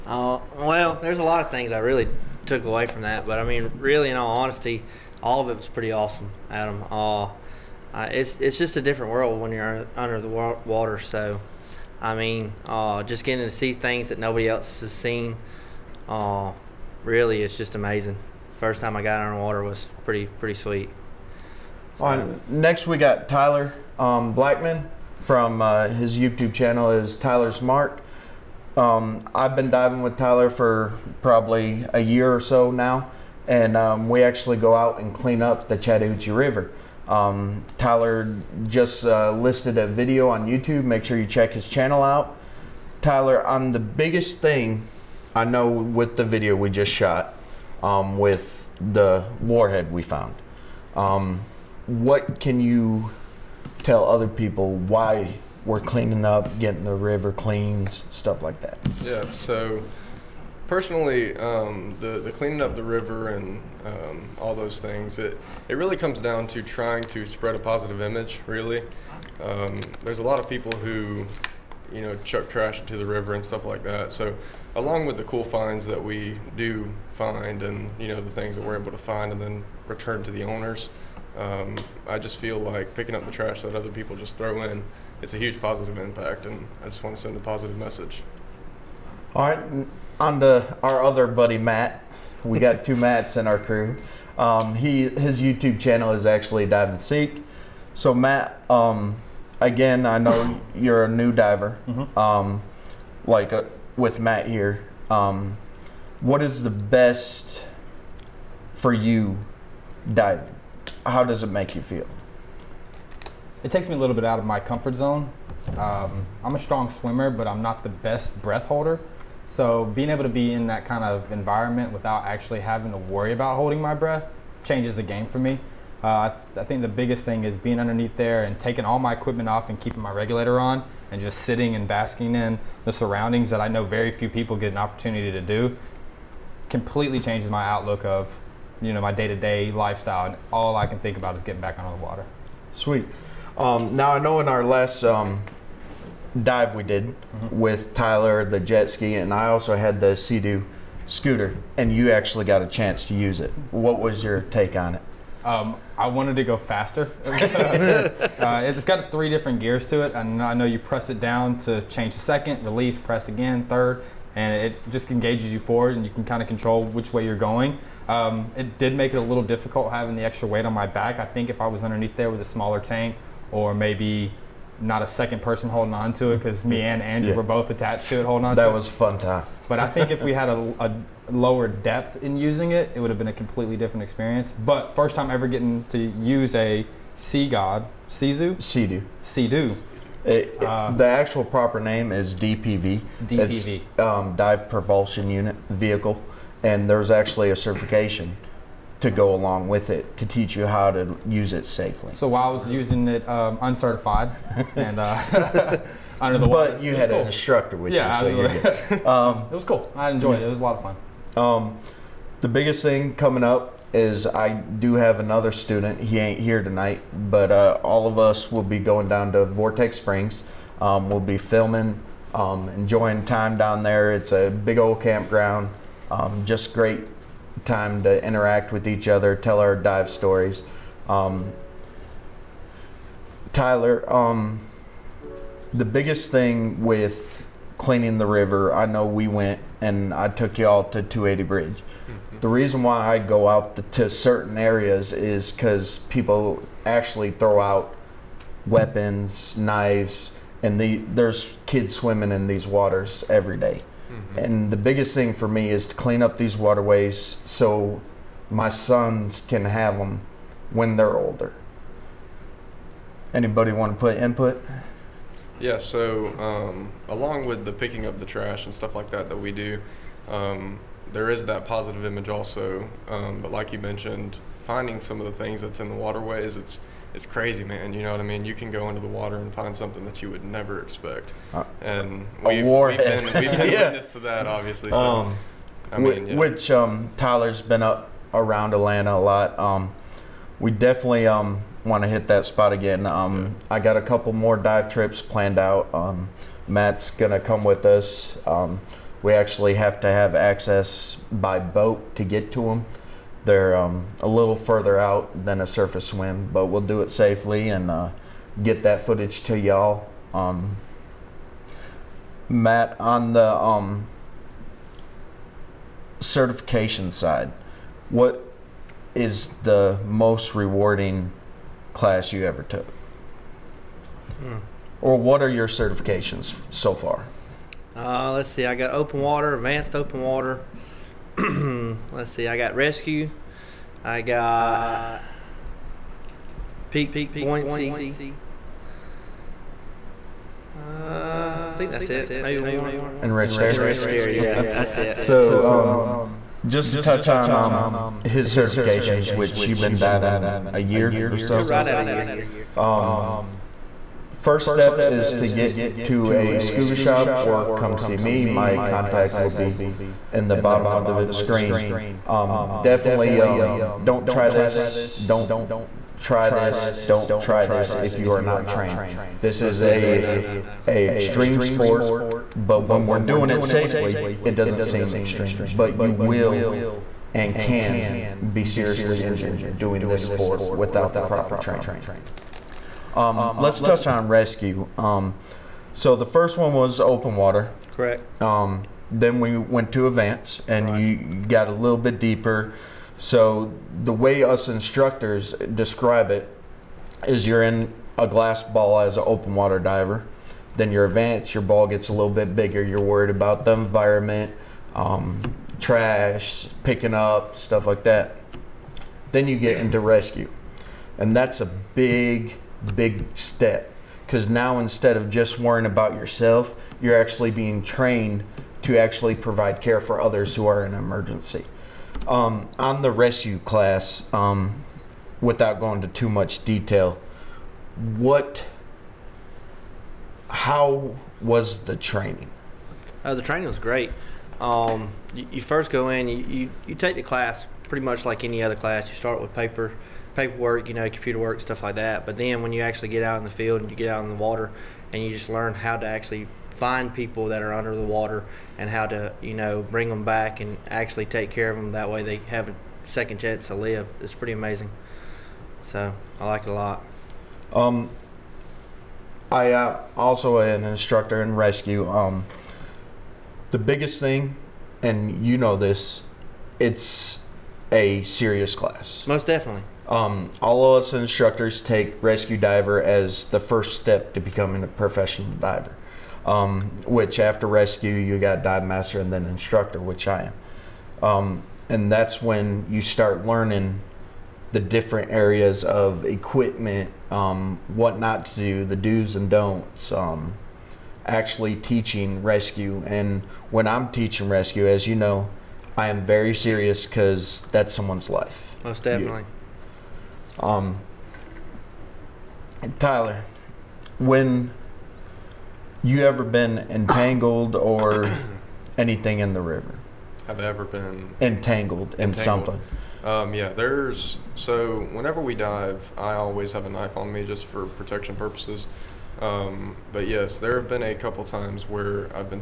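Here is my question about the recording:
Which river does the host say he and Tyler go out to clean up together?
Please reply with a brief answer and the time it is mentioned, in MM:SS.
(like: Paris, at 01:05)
Chattahoochee River, at 00:35.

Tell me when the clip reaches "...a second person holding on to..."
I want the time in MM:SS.
02:55.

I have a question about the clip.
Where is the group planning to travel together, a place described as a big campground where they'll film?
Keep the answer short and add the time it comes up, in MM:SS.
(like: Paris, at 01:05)
Vortex Springs, at 03:39.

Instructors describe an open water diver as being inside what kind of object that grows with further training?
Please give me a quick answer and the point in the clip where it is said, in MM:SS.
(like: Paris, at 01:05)
glass ball, at 06:38.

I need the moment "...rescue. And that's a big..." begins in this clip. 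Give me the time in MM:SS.
06:49.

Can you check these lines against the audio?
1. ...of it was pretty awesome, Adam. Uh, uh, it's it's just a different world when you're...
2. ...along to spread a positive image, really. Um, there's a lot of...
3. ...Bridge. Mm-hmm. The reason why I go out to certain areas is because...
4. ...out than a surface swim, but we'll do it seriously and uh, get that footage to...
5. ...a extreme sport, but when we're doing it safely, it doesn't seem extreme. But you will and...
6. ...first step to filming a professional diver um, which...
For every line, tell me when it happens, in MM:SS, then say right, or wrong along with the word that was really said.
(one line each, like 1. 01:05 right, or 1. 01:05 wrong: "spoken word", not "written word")
1. 00:05 right
2. 01:06 wrong: "trying", not "along"
3. 04:01 right
4. 05:04 wrong: "safely", not "seriously"
5. 06:10 right
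6. 07:53 wrong: "becoming", not "filming".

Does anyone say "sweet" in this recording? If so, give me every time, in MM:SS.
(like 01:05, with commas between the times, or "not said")
00:20, 02:22.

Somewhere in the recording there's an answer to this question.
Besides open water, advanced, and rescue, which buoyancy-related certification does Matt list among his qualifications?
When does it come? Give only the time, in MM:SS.
05:36.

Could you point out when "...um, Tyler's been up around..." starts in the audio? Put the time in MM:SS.
04:46.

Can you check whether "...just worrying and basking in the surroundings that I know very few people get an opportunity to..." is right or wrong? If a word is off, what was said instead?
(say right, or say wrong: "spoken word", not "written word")
wrong: "sitting", not "worrying".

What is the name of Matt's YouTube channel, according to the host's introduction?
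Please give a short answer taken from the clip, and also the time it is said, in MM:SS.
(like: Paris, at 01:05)
Dive and Seek, at 01:36.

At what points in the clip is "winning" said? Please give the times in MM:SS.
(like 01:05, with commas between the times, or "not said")
not said.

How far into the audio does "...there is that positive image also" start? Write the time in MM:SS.
04:31.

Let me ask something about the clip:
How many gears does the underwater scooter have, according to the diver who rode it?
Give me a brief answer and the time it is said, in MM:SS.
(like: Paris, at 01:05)
3, at 02:39.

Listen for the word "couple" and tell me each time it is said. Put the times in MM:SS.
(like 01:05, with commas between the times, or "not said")
04:54, 08:41.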